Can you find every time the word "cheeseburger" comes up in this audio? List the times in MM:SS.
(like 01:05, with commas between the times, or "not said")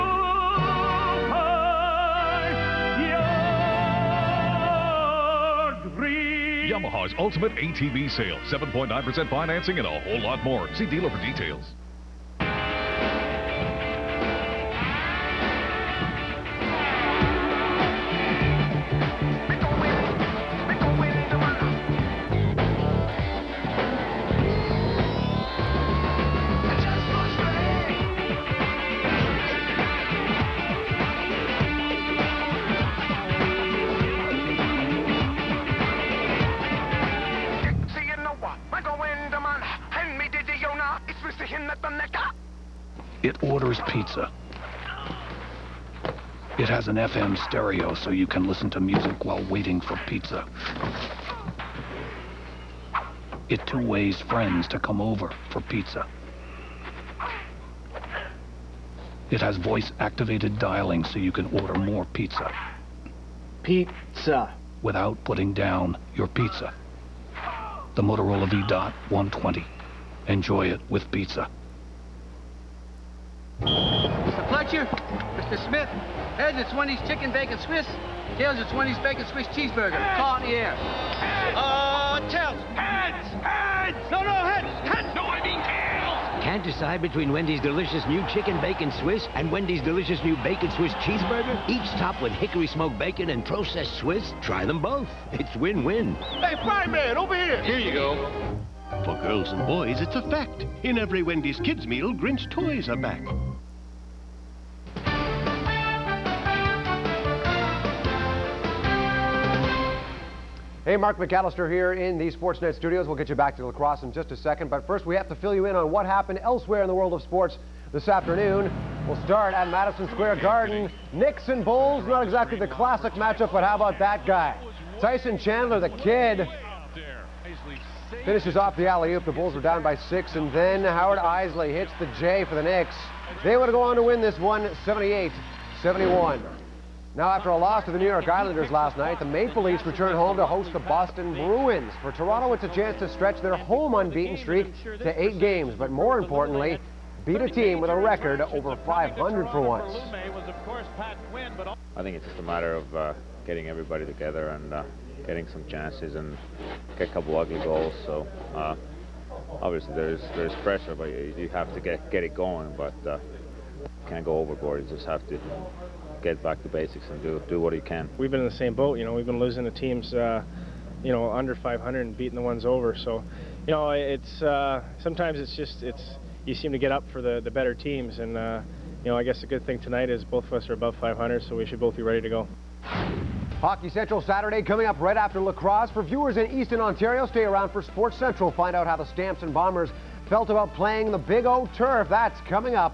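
01:19, 01:31.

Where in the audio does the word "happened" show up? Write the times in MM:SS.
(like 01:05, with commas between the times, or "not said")
01:56.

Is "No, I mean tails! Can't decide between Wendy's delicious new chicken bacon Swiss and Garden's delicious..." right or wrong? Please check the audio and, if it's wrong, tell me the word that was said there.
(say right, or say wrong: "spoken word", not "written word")
wrong: "Wendy", not "Garden".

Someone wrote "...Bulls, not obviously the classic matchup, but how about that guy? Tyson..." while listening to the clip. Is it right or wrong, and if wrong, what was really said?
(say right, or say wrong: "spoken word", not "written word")
wrong: "exactly", not "obviously".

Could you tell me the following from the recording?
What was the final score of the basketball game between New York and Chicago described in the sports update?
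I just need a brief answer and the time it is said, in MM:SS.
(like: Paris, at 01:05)
78-71, at 02:14.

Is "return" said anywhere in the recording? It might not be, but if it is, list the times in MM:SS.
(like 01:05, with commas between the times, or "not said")
02:19.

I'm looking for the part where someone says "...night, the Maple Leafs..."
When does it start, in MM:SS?
02:18.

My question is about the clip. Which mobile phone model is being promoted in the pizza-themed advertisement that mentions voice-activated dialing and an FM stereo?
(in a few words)
Motorola V-Dot 120.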